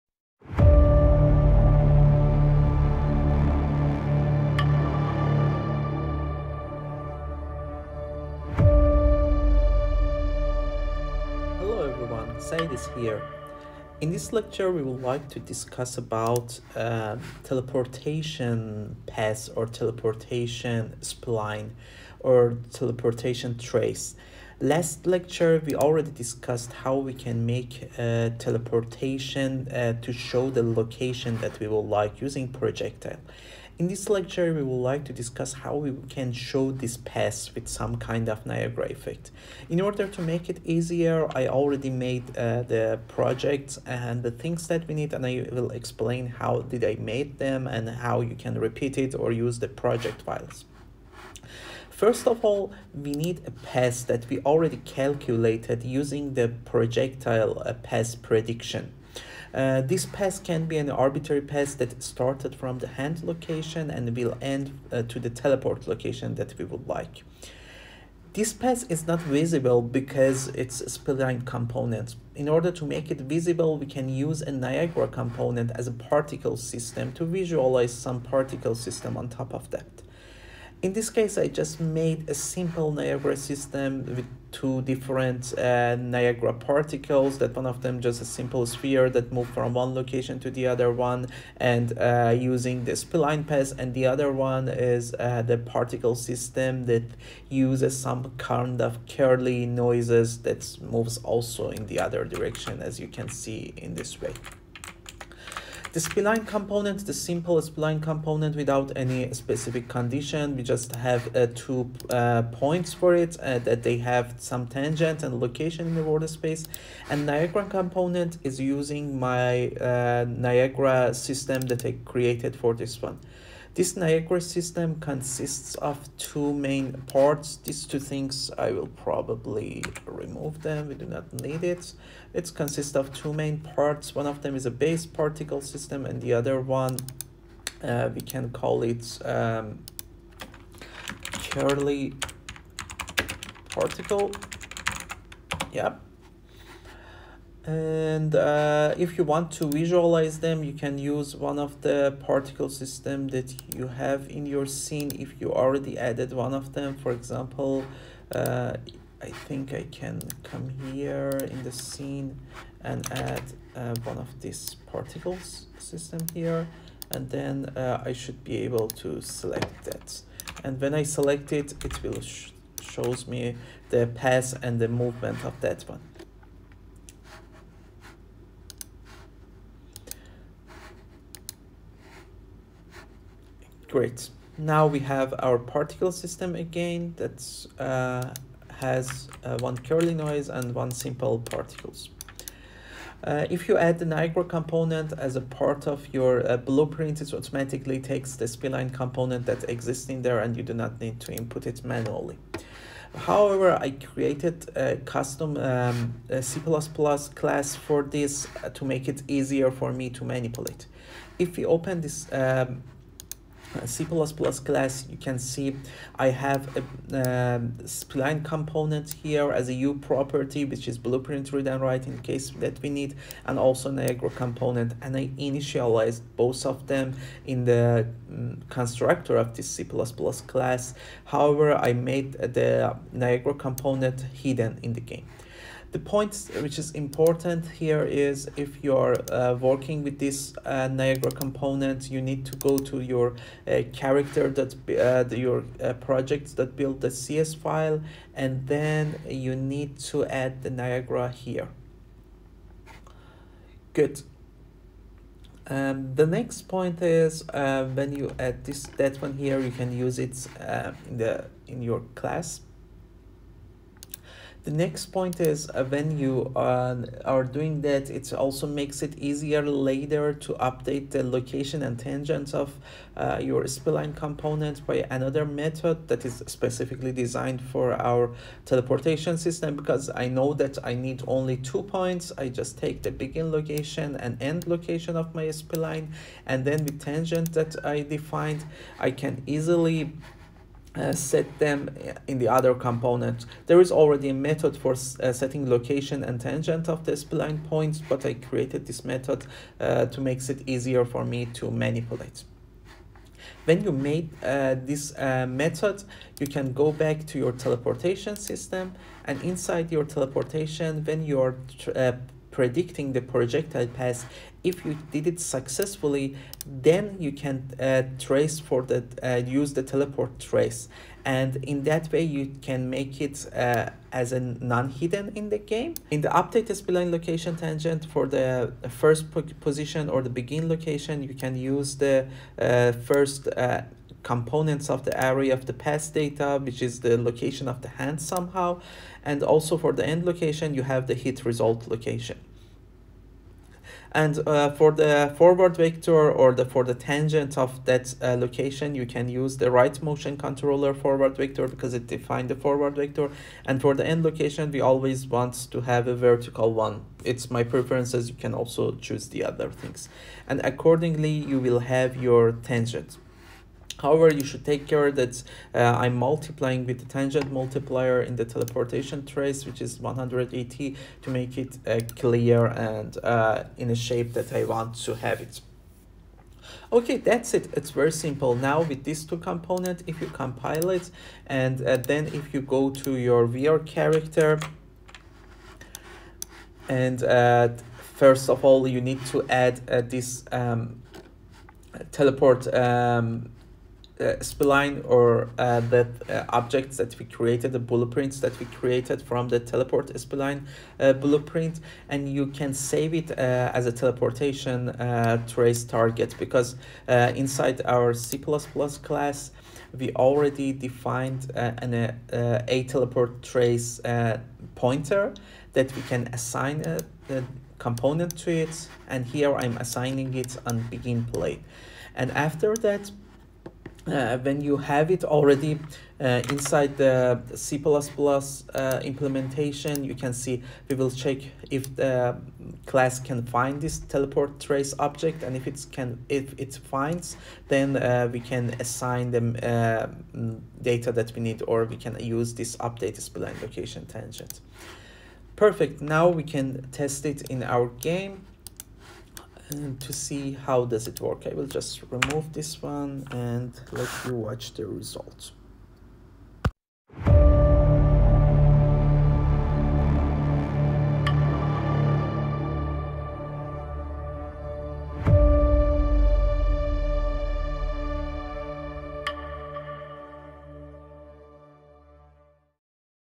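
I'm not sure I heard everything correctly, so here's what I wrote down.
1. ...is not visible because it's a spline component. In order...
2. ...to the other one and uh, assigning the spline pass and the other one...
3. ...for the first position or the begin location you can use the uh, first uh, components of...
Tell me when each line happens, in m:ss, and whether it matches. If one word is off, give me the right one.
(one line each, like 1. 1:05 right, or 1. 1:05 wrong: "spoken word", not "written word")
1. 1:08 right
2. 1:30 wrong: "using", not "assigning"
3. 5:28 right.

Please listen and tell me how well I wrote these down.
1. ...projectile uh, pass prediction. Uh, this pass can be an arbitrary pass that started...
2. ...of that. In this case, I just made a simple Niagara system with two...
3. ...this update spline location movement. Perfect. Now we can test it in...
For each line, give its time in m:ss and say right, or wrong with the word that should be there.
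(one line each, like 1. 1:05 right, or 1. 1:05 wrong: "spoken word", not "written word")
1. 0:56 right
2. 1:19 right
3. 7:22 wrong: "tangent", not "movement".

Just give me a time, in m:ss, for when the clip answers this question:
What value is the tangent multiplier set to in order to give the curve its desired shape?
6:09.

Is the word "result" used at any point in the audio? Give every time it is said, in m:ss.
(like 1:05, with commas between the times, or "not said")
5:41, 7:34.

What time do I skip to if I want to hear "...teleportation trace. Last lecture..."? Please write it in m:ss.
0:22.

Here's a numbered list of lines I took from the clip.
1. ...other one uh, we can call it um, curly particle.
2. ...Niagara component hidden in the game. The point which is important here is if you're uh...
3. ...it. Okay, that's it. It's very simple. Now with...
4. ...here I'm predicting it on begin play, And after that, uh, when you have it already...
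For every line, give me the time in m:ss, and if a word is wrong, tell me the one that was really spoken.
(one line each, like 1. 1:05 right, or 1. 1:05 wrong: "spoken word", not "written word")
1. 2:16 right
2. 3:53 right
3. 6:15 right
4. 6:59 wrong: "assigning", not "predicting".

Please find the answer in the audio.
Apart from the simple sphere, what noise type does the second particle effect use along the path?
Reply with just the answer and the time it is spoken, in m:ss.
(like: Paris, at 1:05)
Curly noise, at 1:39.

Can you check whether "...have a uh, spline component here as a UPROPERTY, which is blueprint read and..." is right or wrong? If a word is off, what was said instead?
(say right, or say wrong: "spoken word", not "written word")
right.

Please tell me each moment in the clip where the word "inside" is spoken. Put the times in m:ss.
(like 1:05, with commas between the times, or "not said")
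5:09, 6:47, 7:06.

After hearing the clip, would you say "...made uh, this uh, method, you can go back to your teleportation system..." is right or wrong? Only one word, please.
right.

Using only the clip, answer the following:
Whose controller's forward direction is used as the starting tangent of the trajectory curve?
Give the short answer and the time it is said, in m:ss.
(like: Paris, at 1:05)
Right motion controller, at 5:49.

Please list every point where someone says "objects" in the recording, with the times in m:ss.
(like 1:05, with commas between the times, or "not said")
6:36, 7:14.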